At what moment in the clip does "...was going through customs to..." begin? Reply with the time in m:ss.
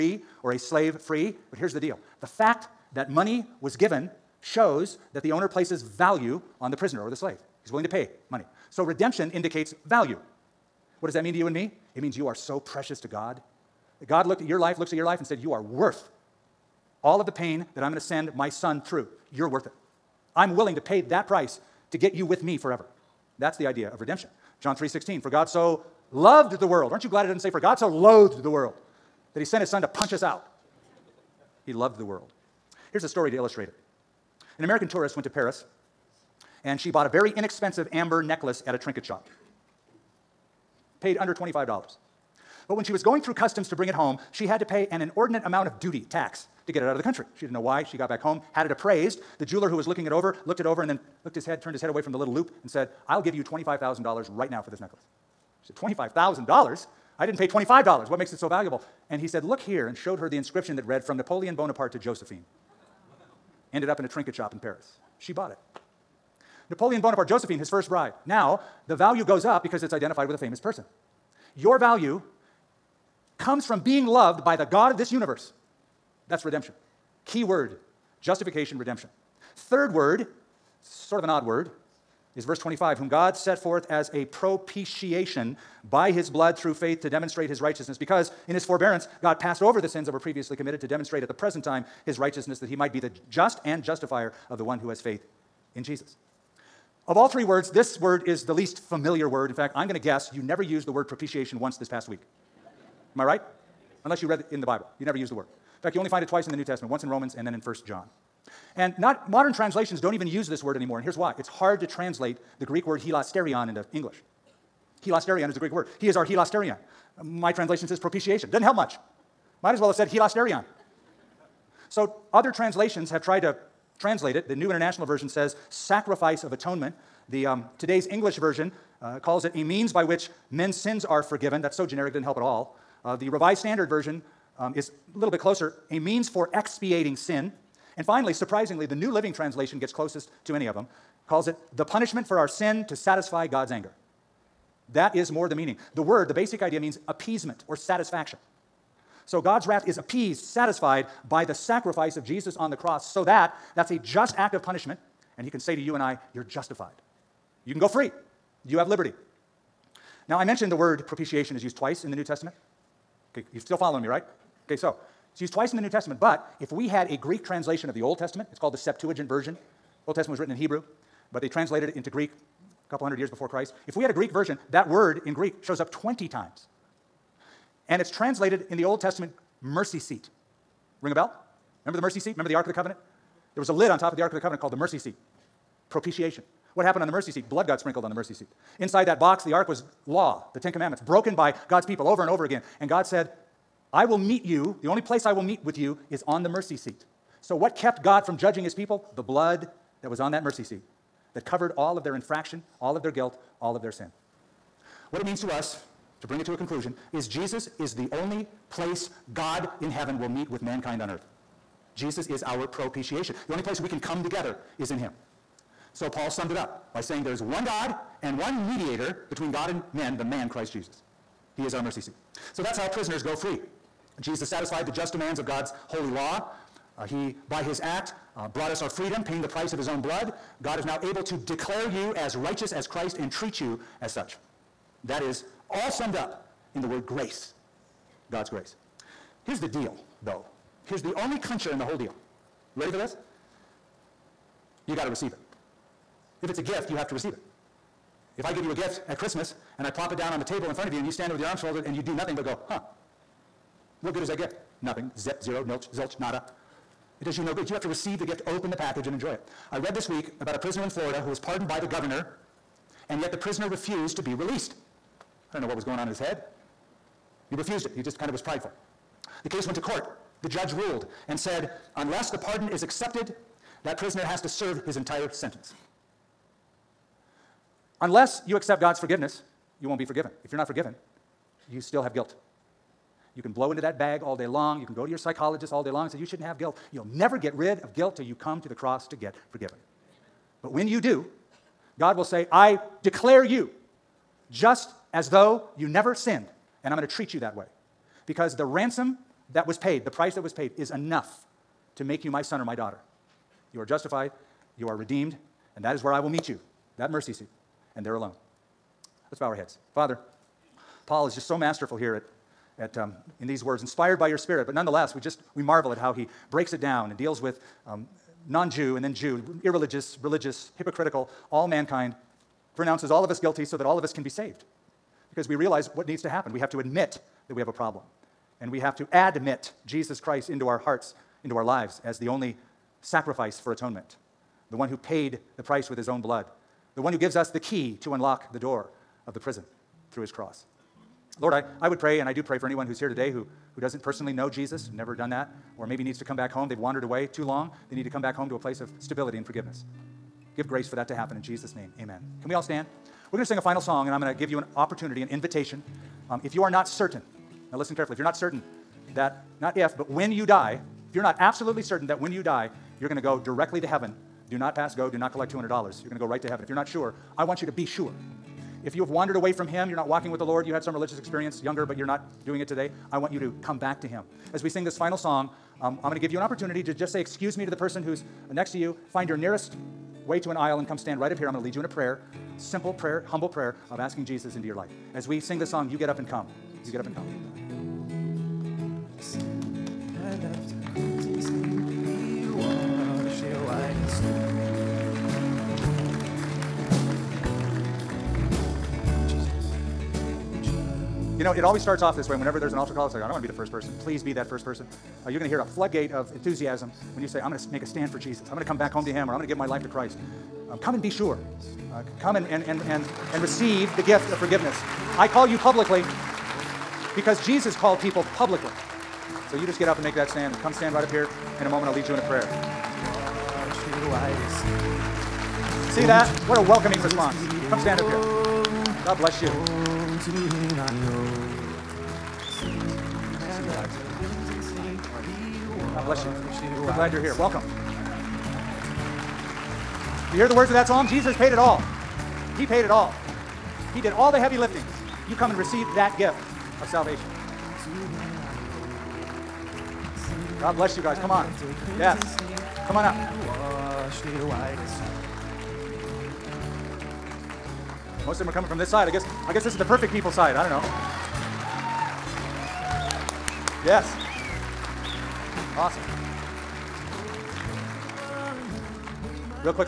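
0:42.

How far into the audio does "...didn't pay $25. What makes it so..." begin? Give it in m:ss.
0:57.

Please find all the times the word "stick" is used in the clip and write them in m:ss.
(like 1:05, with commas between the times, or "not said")
not said.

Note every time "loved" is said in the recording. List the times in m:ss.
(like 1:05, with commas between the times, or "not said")
0:26, 0:31, 1:14.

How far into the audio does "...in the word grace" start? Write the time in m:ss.
3:56.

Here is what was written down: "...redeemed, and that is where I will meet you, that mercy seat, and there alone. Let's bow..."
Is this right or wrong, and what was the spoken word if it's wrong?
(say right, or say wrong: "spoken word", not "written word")
right.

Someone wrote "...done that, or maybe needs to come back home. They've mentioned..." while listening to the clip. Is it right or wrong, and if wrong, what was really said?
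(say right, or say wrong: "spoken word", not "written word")
wrong: "wandered", not "mentioned".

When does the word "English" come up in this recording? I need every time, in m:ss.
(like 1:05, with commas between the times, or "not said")
1:53, 2:08.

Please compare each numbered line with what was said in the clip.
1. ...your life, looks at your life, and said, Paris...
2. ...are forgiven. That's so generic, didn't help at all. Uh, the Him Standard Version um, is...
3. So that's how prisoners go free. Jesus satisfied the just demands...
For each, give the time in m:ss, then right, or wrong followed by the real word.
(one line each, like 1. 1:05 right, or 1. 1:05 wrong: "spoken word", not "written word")
1. 0:14 wrong: "You", not "Paris"
2. 2:11 wrong: "Revised", not "Him"
3. 3:42 right.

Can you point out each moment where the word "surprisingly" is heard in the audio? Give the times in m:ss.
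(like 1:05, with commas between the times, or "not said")
2:18.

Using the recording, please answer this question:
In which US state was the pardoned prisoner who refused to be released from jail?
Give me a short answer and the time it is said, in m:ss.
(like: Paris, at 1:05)
Florida, at 4:20.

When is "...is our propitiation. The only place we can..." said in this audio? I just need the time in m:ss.
3:32.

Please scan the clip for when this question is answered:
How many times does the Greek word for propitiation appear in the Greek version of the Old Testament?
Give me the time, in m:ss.
2:55.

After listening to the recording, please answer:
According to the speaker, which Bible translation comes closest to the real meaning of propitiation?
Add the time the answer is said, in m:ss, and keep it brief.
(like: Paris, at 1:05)
New Living Translation, at 2:18.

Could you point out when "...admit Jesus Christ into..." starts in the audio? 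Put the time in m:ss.
5:29.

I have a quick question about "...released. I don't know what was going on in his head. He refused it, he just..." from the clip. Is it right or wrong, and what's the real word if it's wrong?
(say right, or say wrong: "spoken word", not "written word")
right.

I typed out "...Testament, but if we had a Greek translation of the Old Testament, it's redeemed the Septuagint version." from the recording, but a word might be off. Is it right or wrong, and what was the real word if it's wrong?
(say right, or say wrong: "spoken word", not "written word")
wrong: "called", not "redeemed".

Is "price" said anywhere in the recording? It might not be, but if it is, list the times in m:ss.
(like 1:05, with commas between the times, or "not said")
0:21, 3:49, 5:00, 5:35.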